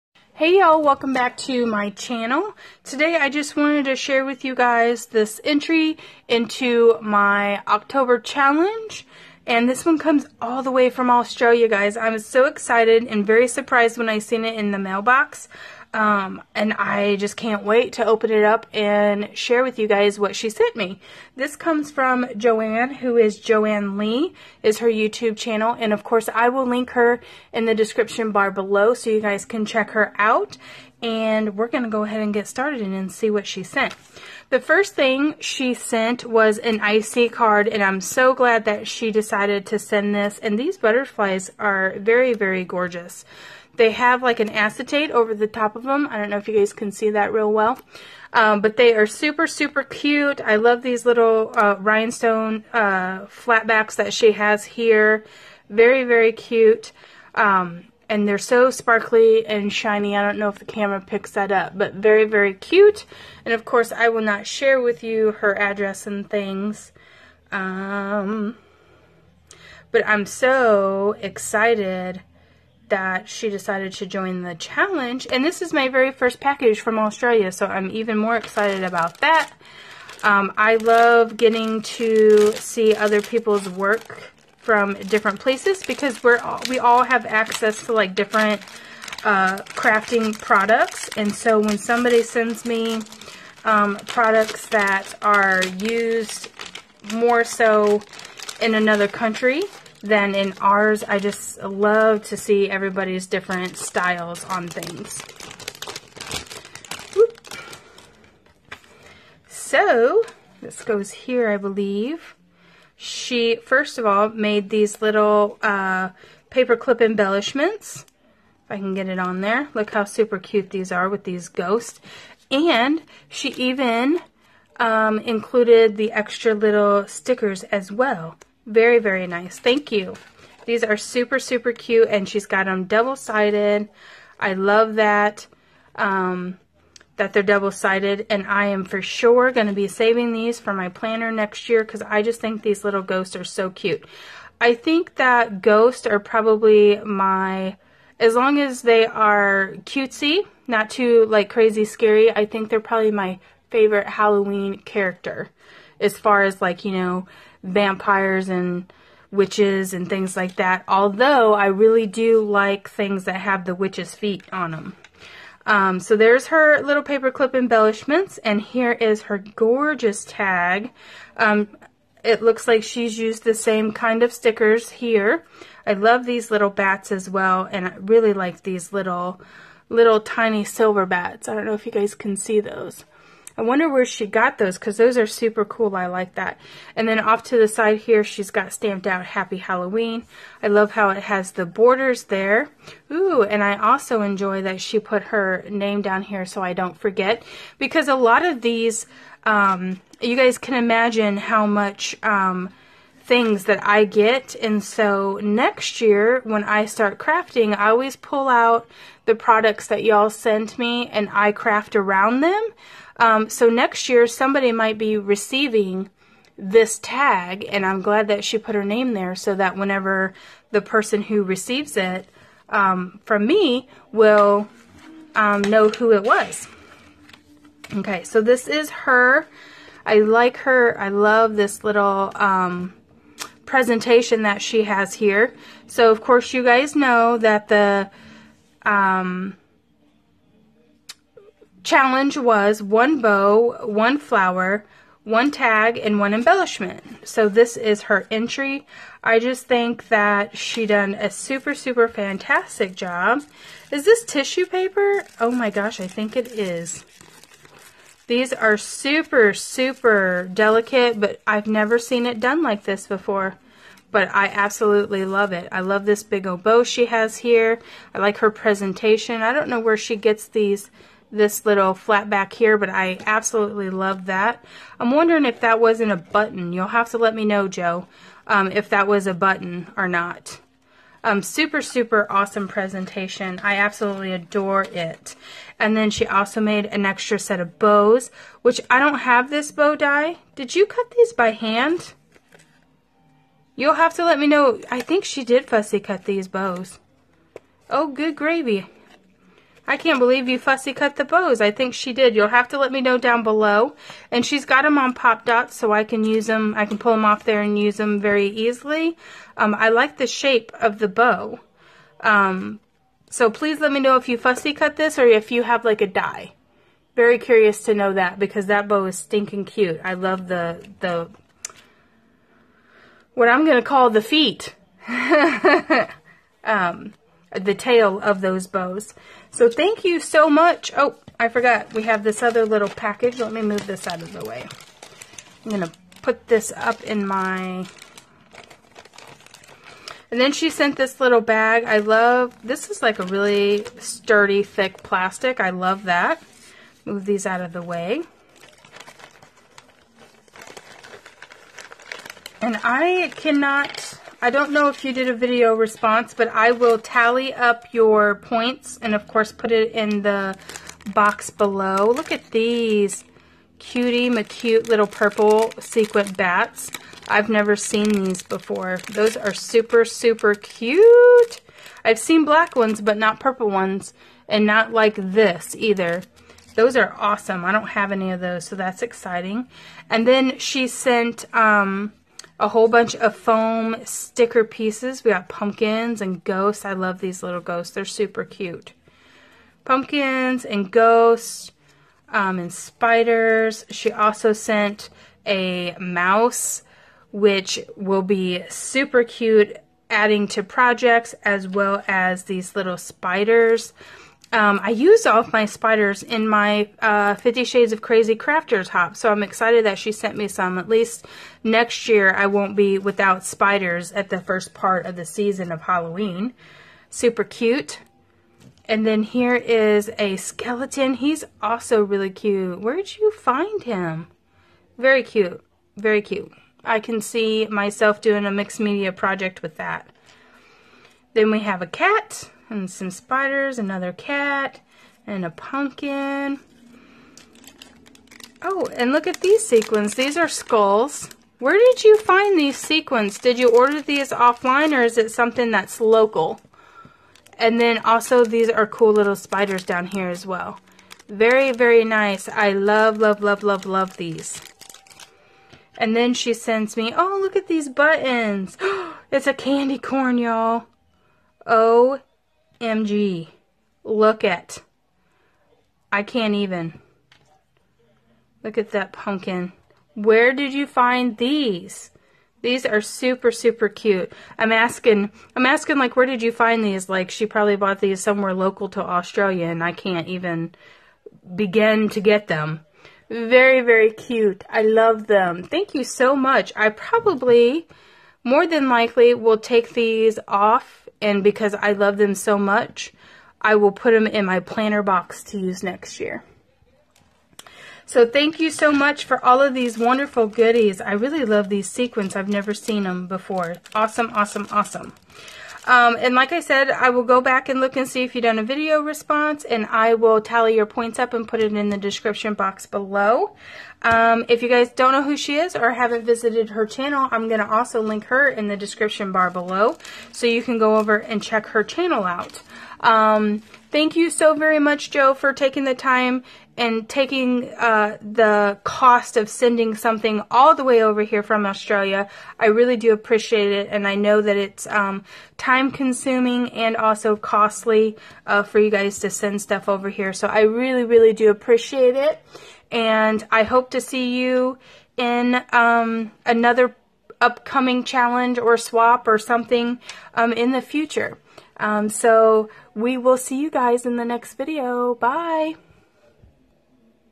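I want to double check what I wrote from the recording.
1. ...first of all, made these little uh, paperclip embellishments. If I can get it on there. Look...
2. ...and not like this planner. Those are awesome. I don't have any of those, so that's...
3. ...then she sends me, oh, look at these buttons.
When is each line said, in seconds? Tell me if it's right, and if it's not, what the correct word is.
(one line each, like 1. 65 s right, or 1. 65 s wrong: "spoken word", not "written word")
1. 113 s right
2. 374 s wrong: "either", not "planner"
3. 456 s right.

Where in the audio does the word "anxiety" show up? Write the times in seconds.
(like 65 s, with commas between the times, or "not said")
not said.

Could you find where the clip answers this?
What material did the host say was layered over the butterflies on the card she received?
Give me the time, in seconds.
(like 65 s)
44 s.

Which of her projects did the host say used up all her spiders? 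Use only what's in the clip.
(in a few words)
Fifty Shades of Crazy Crafter.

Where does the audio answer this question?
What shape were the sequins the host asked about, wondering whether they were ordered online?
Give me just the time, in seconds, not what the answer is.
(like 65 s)
440 s.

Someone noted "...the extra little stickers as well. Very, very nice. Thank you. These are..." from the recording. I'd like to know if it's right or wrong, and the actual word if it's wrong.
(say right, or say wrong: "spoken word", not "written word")
right.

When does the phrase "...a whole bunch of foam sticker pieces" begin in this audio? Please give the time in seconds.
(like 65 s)
382 s.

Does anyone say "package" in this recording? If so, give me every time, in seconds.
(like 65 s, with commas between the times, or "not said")
76 s, 332 s.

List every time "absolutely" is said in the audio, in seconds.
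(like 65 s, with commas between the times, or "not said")
264 s, 273 s, 283 s.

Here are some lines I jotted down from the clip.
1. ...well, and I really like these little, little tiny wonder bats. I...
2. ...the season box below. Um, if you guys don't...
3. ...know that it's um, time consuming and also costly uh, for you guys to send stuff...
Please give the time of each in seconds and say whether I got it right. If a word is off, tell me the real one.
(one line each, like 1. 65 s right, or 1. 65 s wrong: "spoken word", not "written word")
1. 177 s wrong: "silver", not "wonder"
2. 511 s wrong: "description", not "season"
3. 534 s right.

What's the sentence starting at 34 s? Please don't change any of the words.
The first thing she sent was an IC card, and I'm so glad that she decided to send this.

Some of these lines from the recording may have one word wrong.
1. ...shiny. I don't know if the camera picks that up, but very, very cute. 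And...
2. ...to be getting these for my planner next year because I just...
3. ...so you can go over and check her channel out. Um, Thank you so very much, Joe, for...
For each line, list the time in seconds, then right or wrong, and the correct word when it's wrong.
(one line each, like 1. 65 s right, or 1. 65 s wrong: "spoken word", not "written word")
1. 59 s right
2. 139 s wrong: "saving", not "getting"
3. 520 s right.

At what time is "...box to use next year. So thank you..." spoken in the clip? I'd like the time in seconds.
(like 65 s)
495 s.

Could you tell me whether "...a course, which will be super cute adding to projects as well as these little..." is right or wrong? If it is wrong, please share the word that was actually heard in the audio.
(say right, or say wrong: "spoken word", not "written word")
wrong: "mouse", not "course".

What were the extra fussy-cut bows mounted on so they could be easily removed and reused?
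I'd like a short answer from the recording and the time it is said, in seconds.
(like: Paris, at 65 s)
pop dots, at 305 s.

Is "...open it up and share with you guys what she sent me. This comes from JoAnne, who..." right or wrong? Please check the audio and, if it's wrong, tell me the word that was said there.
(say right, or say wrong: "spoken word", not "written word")
right.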